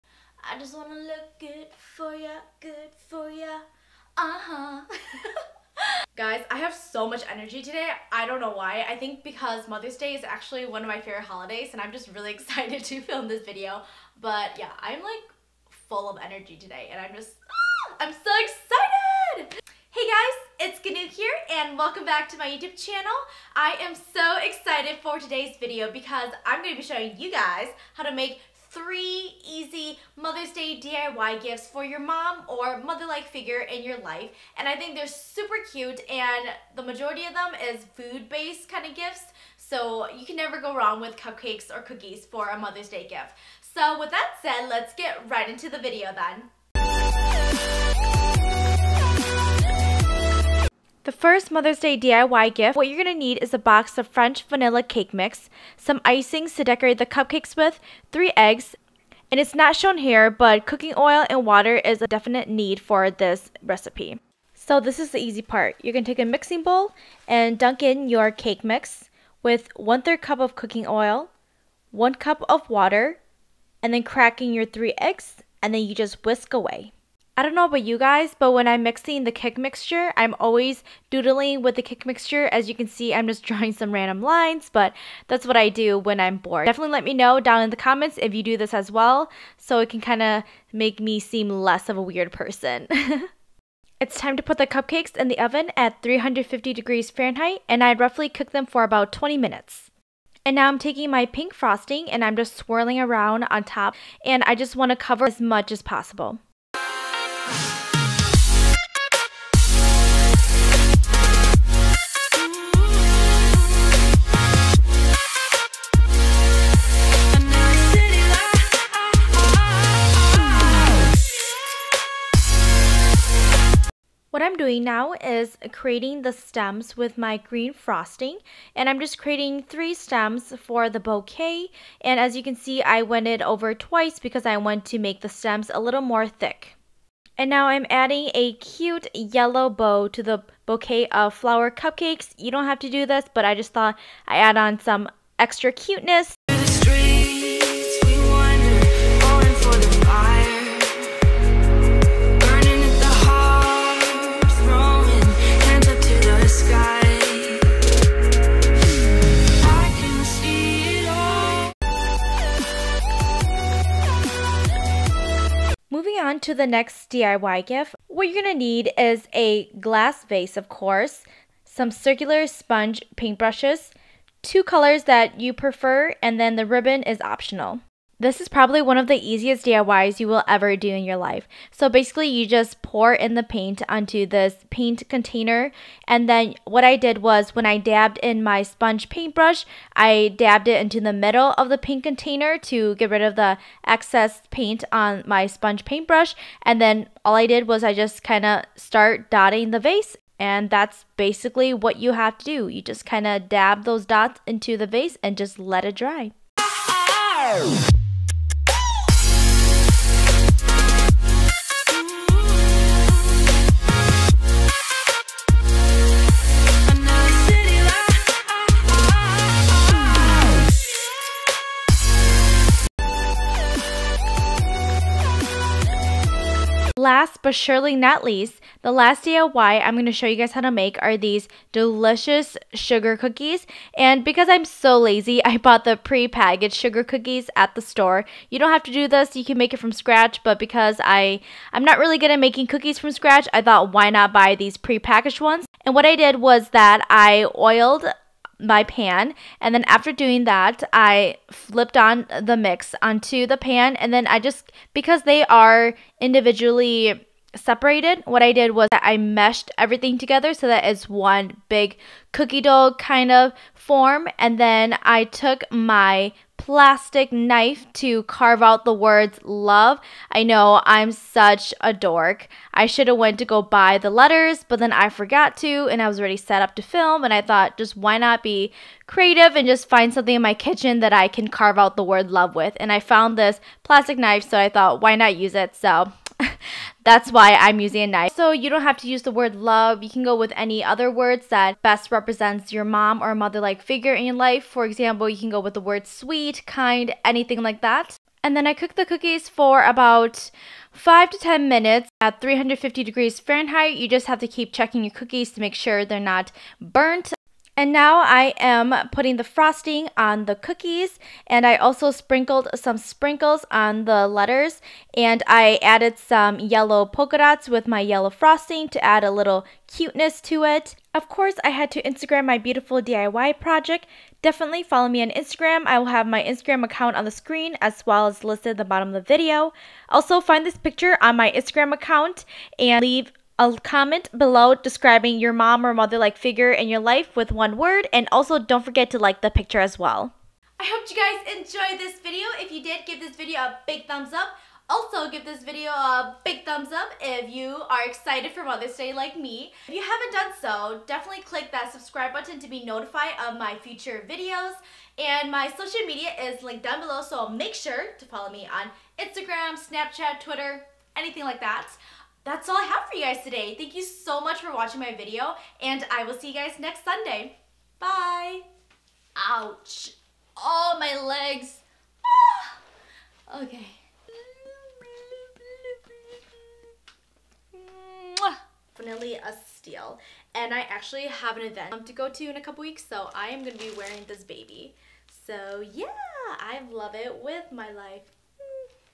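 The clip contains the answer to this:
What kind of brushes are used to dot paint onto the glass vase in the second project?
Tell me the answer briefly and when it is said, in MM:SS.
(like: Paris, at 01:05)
Circular sponge paintbrushes, at 02:51.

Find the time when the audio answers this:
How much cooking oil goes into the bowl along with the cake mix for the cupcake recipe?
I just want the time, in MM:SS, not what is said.
01:09.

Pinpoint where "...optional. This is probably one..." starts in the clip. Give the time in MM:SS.
02:57.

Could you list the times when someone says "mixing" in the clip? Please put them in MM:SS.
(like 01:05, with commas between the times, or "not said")
01:06, 01:18.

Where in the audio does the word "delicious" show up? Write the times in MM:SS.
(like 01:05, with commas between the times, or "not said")
03:51.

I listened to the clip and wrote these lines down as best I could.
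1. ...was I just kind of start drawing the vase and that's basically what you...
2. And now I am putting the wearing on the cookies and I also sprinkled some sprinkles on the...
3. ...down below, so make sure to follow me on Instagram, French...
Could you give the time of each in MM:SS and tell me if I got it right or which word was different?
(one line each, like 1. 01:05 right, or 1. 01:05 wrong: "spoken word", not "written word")
1. 03:17 wrong: "dotting", not "drawing"
2. 05:07 wrong: "frosting", not "wearing"
3. 05:56 wrong: "Snapchat", not "French".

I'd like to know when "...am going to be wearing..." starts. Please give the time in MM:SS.
06:23.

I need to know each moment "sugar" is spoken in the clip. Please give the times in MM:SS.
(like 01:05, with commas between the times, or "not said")
03:52, 03:56.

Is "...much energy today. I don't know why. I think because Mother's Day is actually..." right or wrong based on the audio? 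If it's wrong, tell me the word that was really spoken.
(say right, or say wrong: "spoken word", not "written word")
right.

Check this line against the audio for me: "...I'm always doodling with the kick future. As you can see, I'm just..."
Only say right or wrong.
wrong.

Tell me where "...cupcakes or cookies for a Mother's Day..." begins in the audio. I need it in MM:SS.
00:41.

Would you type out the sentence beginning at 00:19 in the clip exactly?
Hey guys, it's Gaonou here and welcome back to my YouTube channel.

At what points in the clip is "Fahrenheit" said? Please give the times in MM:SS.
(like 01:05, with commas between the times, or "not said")
01:37, 05:03.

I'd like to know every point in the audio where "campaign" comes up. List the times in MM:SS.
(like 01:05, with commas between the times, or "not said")
not said.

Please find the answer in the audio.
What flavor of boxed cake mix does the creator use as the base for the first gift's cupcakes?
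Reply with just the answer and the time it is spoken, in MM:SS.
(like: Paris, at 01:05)
French vanilla, at 00:54.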